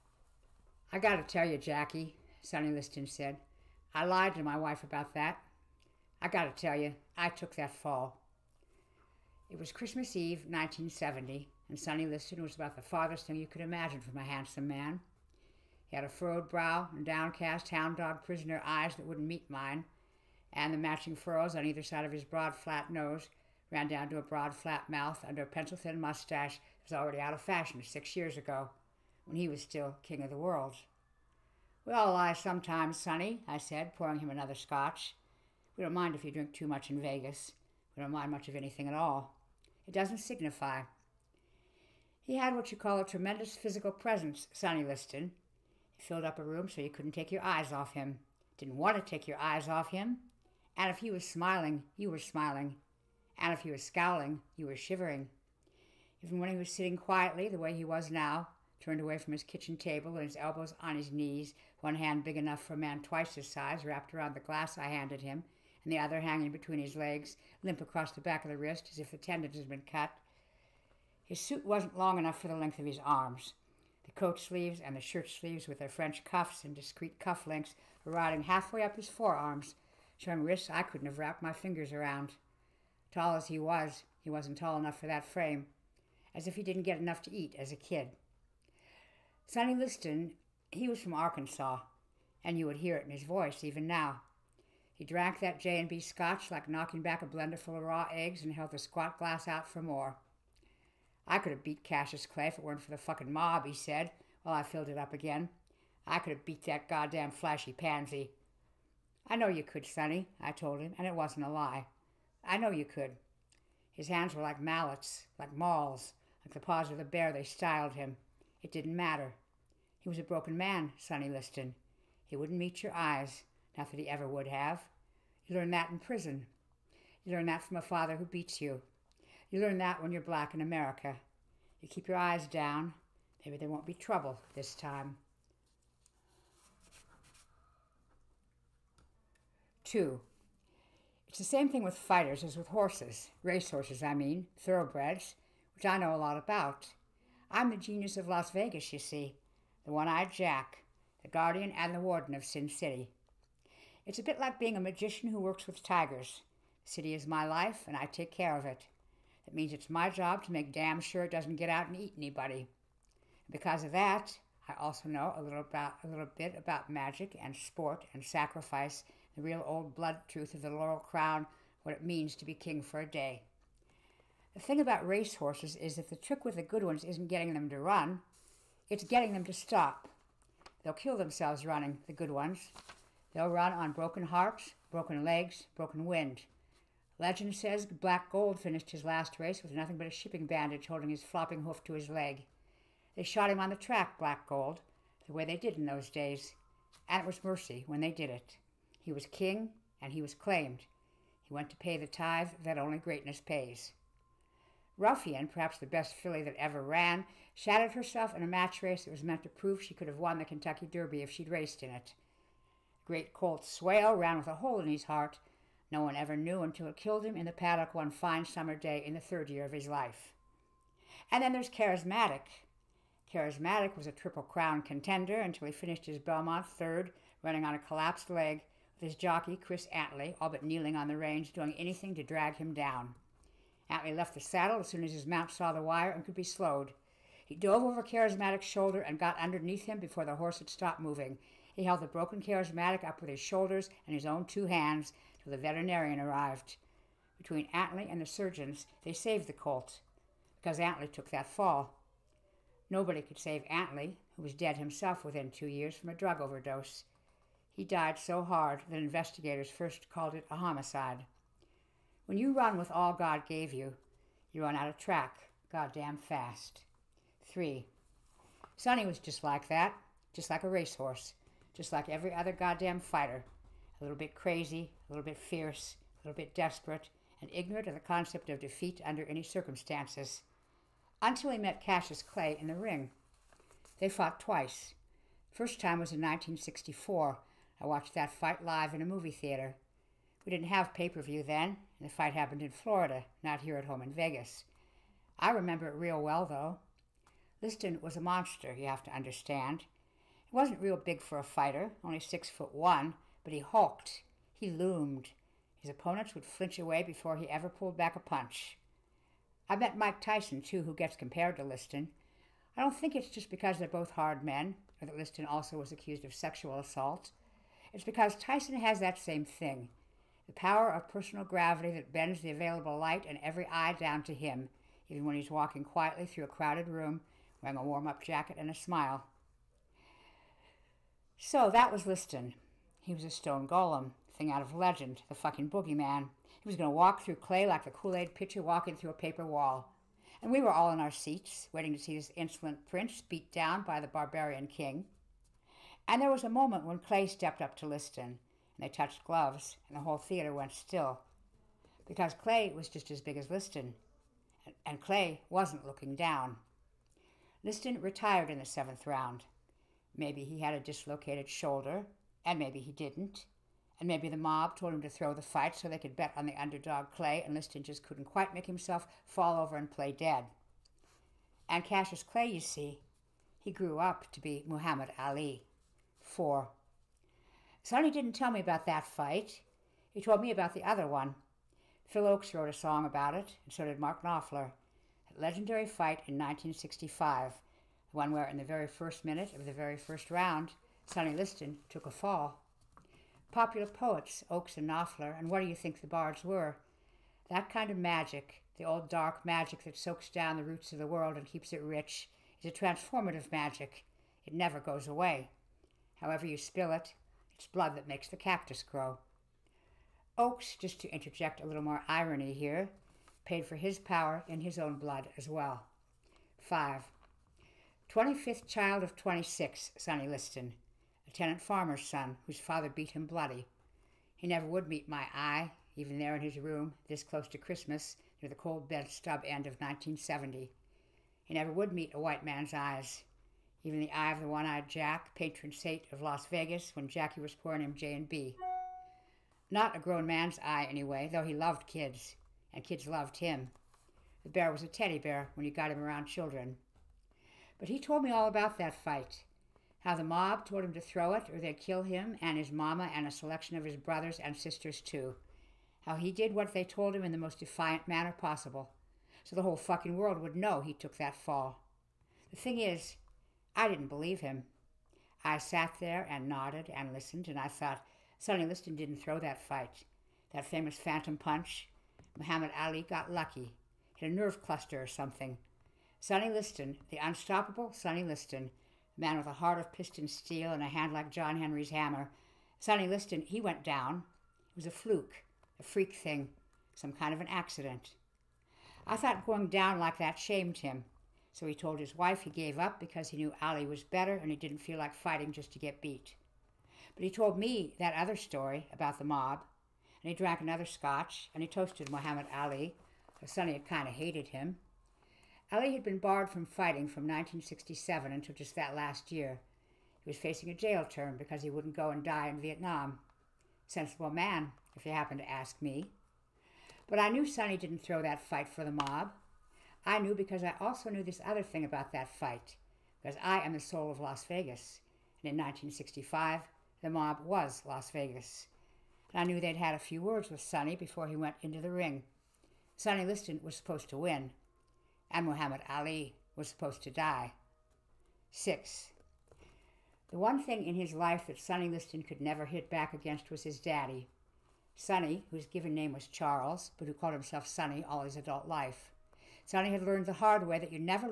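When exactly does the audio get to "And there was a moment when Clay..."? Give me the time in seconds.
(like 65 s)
346 s.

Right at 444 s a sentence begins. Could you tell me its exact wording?
The bear was a teddy bear when you got him around children.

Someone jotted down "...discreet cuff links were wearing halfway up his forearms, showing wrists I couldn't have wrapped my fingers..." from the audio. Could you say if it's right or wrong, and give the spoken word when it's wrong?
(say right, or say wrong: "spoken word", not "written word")
wrong: "riding", not "wearing".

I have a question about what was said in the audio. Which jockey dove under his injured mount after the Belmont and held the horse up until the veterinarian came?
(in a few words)
Chris Antley.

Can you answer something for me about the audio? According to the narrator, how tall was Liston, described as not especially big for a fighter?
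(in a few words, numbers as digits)
6 foot 1.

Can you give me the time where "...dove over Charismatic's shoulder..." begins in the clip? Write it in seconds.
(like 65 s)
237 s.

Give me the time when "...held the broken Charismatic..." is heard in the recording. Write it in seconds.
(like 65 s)
241 s.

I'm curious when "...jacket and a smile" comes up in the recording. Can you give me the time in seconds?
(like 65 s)
328 s.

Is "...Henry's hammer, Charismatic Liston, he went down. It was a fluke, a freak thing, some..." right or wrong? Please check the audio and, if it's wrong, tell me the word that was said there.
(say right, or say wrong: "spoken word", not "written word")
wrong: "Sonny", not "Charismatic".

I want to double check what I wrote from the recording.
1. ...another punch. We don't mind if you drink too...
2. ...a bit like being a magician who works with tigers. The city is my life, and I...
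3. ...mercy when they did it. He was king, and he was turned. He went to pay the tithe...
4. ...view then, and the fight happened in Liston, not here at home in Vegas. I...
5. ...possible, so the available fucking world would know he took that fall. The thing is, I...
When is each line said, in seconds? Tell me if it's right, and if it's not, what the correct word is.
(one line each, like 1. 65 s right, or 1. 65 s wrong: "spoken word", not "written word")
1. 34 s wrong: "scotch", not "punch"
2. 154 s right
3. 197 s wrong: "claimed", not "turned"
4. 291 s wrong: "Florida", not "Liston"
5. 458 s wrong: "whole", not "available".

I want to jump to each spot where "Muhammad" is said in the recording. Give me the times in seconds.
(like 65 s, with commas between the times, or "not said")
374 s, 472 s, 502 s, 535 s.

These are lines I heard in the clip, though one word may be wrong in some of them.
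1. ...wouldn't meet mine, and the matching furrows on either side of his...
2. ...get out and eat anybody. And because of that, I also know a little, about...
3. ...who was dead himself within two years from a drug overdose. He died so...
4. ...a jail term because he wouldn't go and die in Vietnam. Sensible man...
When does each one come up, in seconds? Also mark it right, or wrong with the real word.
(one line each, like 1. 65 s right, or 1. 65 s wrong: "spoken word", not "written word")
1. 19 s right
2. 161 s right
3. 254 s right
4. 510 s right.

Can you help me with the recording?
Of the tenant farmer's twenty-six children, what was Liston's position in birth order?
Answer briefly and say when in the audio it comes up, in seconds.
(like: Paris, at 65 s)
25th, at 418 s.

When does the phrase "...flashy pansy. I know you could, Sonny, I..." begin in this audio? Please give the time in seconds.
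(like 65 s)
107 s.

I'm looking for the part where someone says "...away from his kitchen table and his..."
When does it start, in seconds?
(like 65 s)
59 s.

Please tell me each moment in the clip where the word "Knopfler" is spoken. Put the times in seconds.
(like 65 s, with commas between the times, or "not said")
384 s, 394 s.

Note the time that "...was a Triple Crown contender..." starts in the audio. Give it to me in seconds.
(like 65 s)
223 s.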